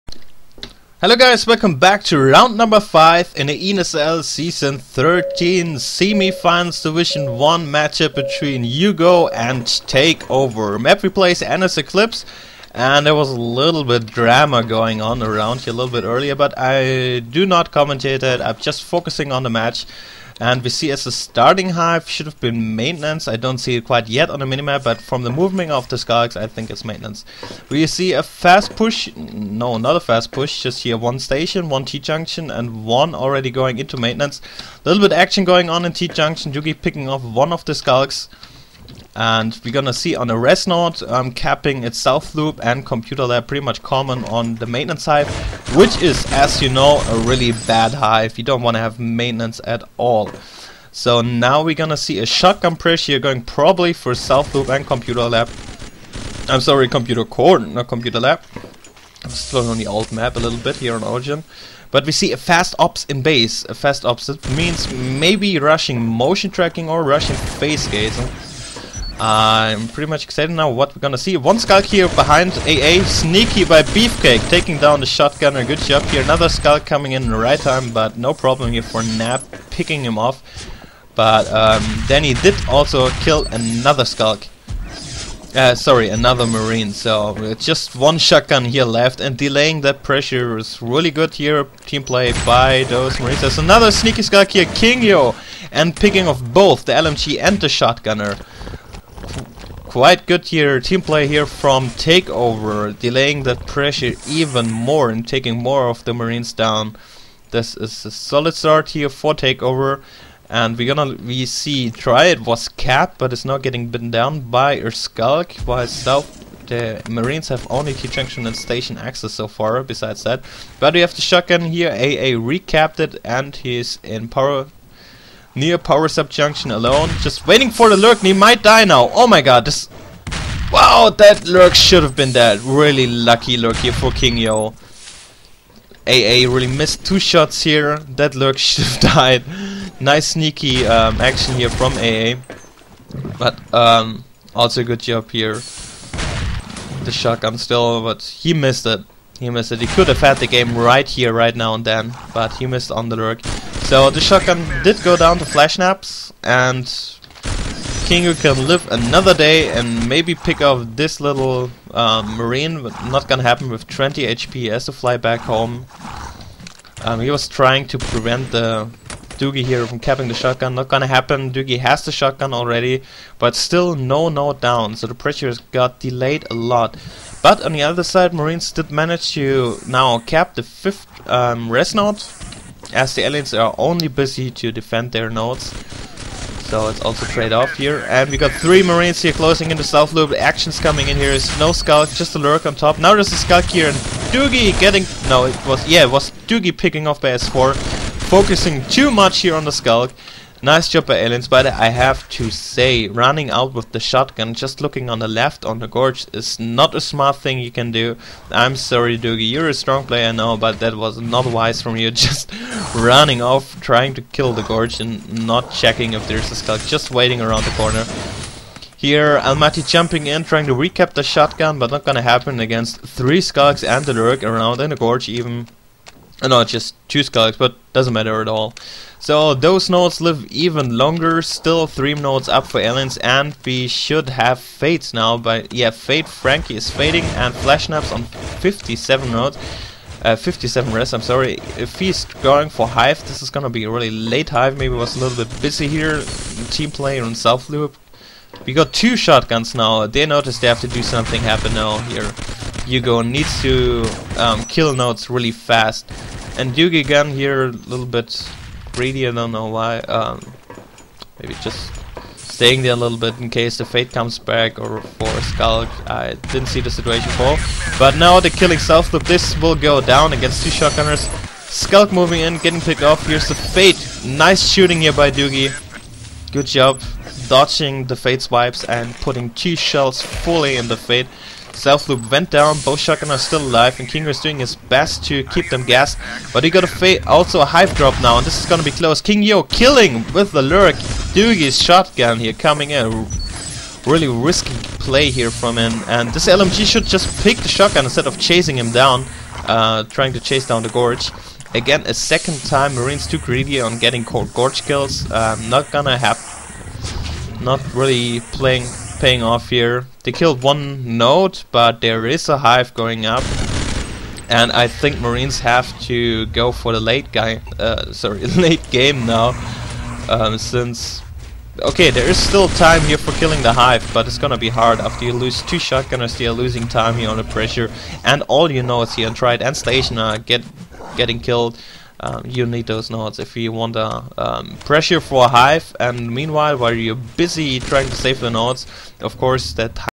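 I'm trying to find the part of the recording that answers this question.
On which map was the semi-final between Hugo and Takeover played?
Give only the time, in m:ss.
0:11.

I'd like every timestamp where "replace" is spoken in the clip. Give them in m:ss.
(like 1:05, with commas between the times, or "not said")
0:11.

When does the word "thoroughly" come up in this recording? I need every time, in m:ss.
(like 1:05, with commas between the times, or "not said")
not said.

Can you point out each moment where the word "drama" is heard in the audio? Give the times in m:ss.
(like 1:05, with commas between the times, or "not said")
0:14.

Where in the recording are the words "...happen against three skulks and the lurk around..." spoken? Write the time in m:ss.
3:42.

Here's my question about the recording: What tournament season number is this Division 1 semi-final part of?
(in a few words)
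13.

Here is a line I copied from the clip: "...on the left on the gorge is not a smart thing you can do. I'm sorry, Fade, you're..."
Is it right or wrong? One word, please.
wrong.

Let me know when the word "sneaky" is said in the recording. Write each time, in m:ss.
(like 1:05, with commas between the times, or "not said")
1:13, 1:33, 2:20.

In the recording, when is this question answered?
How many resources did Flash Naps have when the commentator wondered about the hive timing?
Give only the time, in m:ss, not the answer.
4:00.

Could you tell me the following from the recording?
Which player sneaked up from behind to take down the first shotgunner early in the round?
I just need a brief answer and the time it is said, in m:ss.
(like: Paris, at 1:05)
Beefcake, at 1:13.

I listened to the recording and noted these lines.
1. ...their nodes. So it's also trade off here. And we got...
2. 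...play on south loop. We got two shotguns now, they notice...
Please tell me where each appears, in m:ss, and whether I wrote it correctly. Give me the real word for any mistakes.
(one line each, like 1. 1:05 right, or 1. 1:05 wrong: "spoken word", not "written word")
1. 3:05 right
2. 4:06 right.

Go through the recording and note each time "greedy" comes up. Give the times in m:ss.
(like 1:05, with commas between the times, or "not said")
4:18, 5:03.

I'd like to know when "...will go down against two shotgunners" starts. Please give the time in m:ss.
4:29.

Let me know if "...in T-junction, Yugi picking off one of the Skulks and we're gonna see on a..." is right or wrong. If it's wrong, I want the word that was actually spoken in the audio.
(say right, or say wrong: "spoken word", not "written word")
right.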